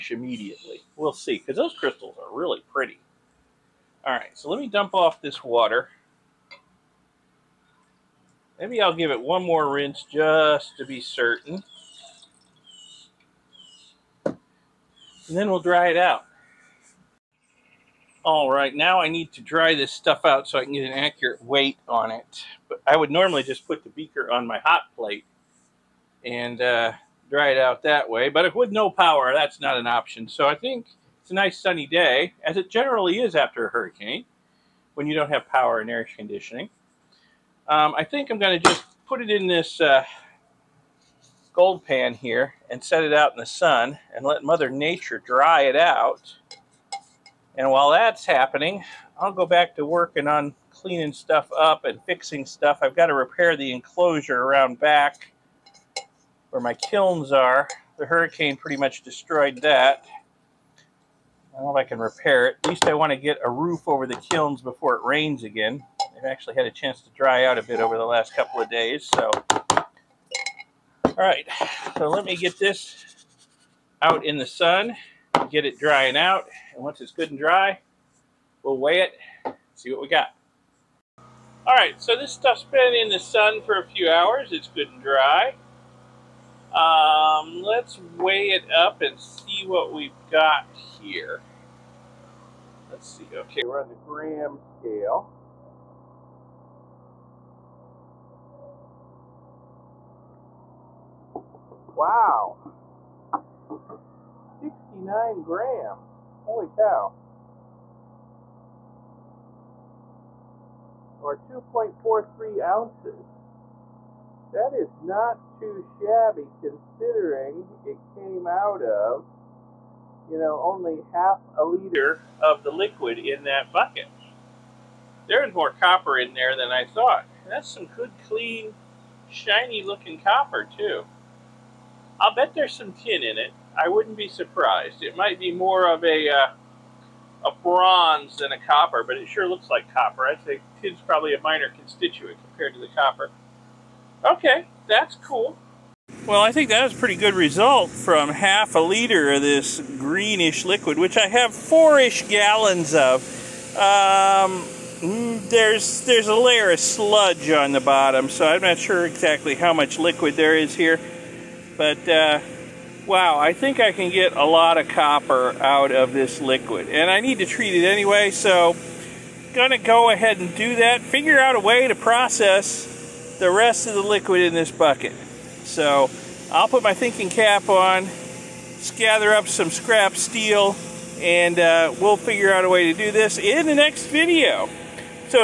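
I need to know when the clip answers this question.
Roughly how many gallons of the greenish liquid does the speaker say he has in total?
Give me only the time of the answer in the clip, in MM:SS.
02:31.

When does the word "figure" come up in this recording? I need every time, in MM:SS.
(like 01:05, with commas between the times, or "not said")
02:51, 03:02.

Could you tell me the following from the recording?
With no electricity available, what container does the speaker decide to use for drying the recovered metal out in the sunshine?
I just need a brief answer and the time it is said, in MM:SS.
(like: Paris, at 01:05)
Gold pan, at 00:41.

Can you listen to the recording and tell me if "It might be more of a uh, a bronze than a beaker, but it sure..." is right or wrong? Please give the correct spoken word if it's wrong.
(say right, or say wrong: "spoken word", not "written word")
wrong: "copper", not "beaker".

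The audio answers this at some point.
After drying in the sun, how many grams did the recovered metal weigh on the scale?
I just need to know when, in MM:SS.
01:44.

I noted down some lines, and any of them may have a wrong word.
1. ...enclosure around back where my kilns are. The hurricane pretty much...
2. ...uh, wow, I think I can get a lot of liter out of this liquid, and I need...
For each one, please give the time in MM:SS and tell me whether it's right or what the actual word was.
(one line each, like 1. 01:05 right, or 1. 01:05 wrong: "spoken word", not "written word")
1. 00:53 right
2. 02:42 wrong: "copper", not "liter".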